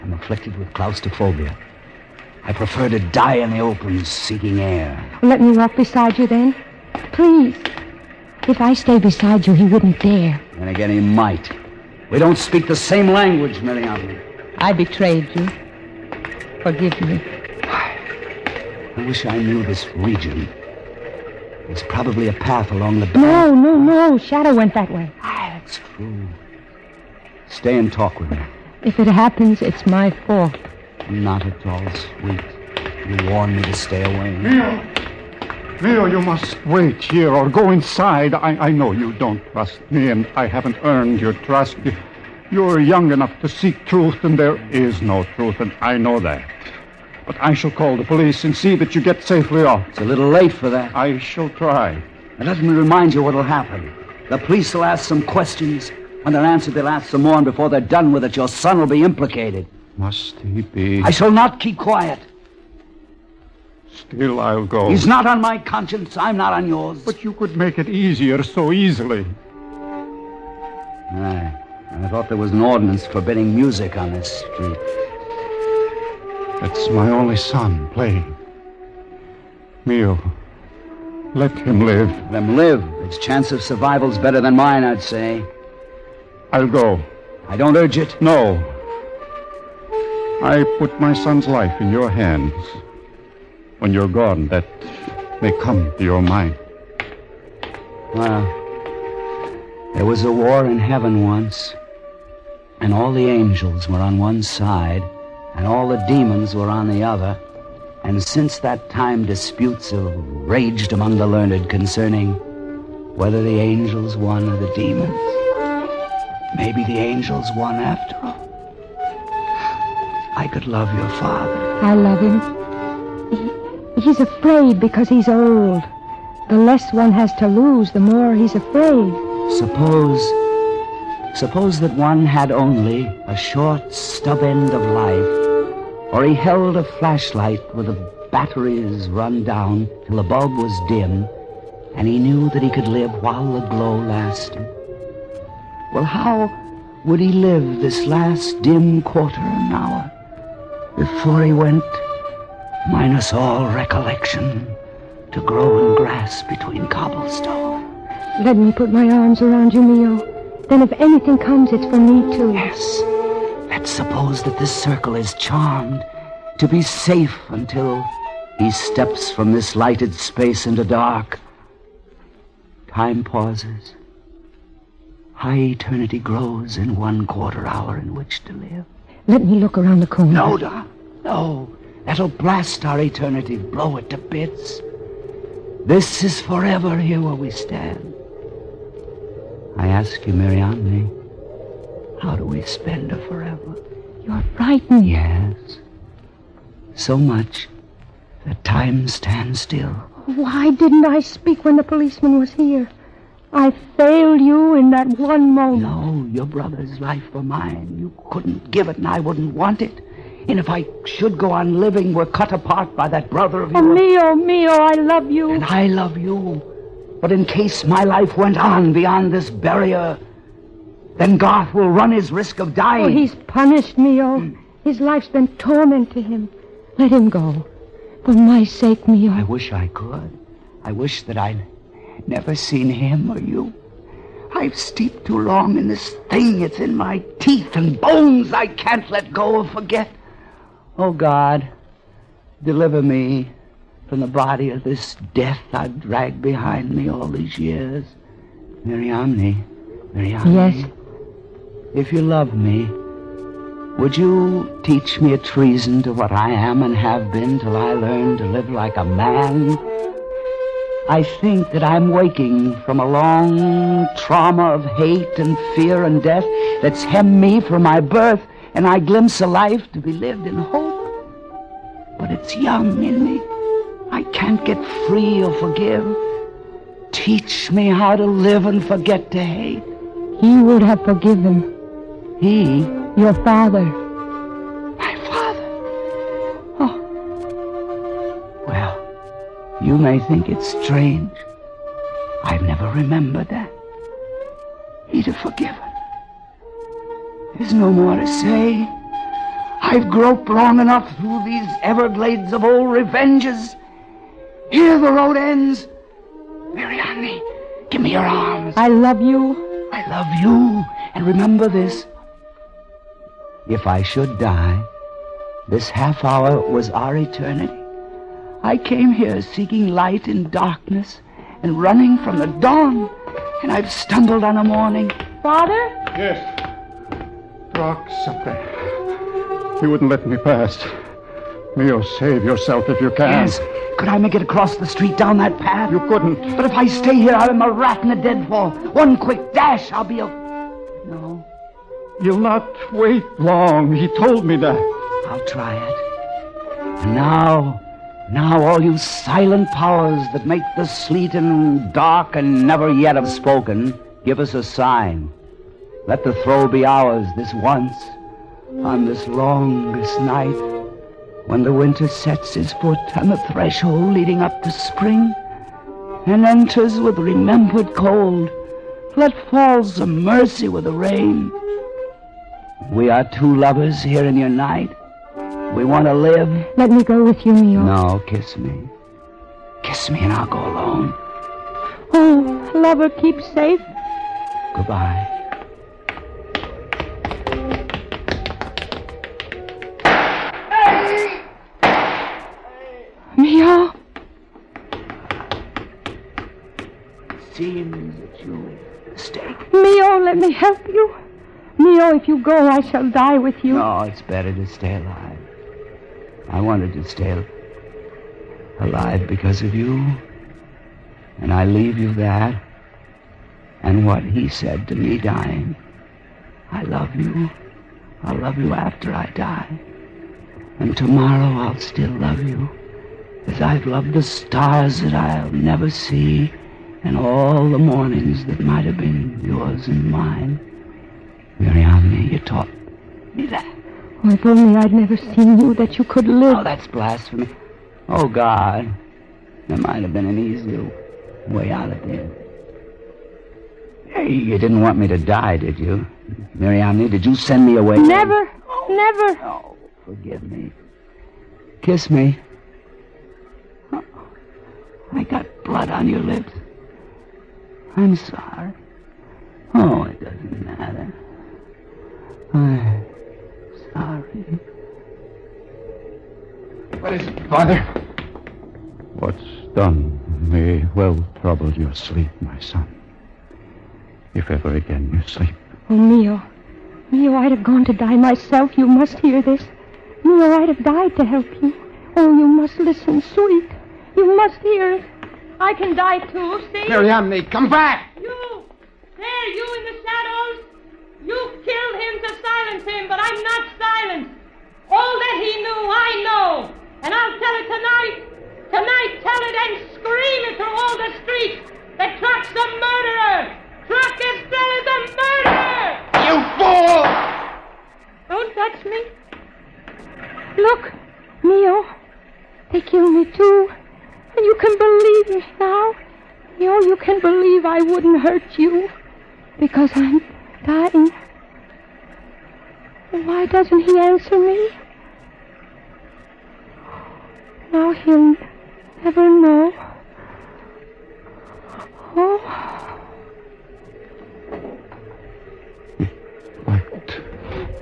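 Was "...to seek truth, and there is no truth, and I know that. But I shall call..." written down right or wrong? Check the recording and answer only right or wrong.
right.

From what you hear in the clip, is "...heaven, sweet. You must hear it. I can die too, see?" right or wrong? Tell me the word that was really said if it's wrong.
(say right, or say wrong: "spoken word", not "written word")
wrong: "listen", not "heaven".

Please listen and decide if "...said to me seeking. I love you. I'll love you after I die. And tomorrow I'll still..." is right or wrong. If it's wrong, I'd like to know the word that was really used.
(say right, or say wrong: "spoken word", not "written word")
wrong: "dying", not "seeking".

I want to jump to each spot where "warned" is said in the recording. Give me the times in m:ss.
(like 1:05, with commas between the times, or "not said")
0:33.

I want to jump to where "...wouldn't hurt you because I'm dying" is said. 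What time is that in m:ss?
8:37.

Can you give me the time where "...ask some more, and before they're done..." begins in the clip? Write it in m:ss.
0:56.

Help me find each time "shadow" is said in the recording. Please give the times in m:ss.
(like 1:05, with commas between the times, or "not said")
0:24, 8:10.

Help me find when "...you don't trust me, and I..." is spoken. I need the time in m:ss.
0:38.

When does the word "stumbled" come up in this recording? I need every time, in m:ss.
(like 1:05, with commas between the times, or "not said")
5:23.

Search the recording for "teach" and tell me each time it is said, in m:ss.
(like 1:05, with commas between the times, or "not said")
4:14, 4:37.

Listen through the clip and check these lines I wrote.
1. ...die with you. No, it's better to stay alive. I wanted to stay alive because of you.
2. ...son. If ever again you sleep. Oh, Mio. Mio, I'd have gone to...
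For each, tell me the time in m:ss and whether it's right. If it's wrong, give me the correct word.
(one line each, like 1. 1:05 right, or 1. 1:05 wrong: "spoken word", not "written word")
1. 6:43 right
2. 7:52 right.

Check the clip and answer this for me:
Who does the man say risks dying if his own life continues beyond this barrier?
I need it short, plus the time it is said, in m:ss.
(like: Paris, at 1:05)
Garth, at 3:41.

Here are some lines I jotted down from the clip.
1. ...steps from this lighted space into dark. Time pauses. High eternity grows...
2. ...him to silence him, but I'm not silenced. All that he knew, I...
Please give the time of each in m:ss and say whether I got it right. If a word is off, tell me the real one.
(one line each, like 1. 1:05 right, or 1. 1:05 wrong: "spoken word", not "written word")
1. 2:48 right
2. 8:12 right.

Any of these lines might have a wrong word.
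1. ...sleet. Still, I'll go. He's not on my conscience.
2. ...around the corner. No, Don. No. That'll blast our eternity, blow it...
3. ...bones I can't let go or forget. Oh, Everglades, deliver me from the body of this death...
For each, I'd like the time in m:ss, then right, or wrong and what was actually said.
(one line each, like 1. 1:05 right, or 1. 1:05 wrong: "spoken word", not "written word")
1. 1:01 wrong: "quiet", not "sleet"
2. 2:59 right
3. 3:58 wrong: "God", not "Everglades".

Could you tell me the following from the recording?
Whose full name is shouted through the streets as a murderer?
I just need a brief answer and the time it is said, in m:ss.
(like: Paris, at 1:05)
Trock Estrella, at 8:23.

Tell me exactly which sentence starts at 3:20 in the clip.
Why didn't I speak when the policeman was here?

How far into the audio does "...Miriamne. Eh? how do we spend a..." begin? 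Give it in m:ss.
3:10.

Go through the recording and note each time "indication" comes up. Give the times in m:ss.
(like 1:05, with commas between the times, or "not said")
not said.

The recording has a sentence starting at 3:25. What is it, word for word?
No, your brother's life for mine.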